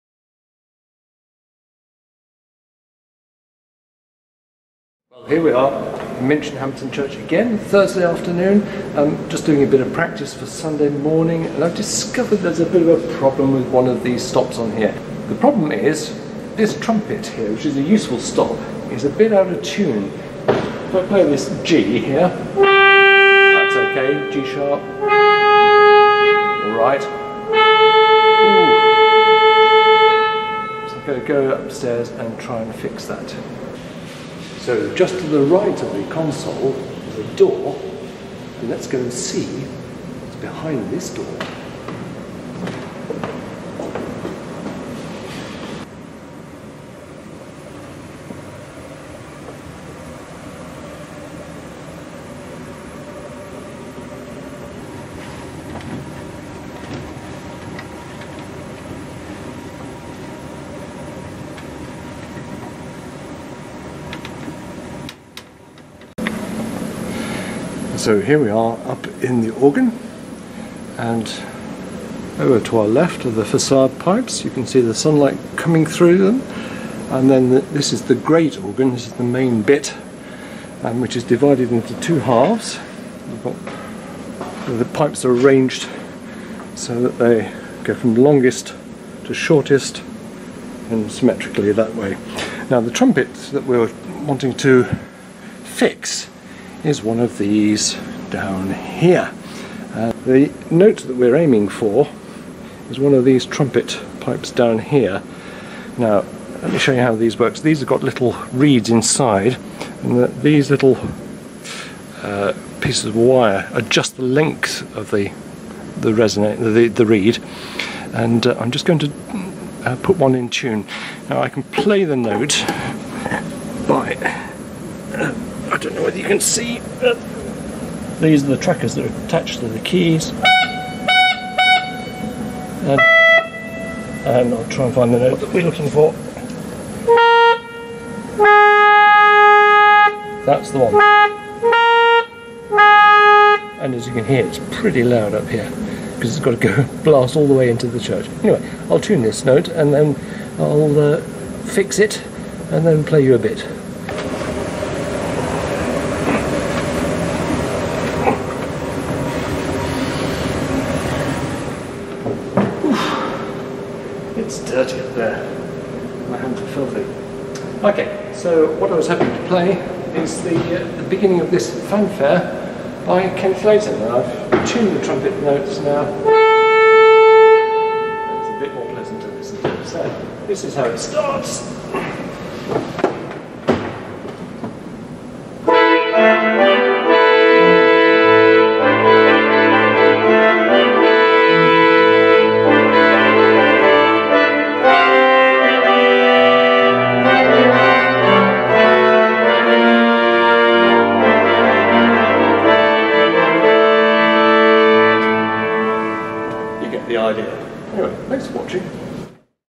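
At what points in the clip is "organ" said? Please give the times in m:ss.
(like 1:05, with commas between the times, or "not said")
1:09, 1:18.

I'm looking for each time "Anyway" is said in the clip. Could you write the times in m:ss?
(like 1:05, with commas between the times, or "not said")
2:28, 3:27.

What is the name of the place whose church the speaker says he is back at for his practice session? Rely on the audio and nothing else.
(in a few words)
Minchinhampton.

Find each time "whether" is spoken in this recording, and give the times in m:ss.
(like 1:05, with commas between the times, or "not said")
2:06.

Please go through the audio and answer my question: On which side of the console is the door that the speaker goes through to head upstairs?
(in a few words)
The right.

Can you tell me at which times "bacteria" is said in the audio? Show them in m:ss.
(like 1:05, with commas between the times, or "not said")
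not said.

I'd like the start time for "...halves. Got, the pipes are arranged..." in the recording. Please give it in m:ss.
1:22.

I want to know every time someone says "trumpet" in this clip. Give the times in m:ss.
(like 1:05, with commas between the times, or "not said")
0:16, 1:32, 1:43, 2:55.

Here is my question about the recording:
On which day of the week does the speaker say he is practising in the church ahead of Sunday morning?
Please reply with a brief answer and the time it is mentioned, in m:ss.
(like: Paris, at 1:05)
Thursday, at 0:07.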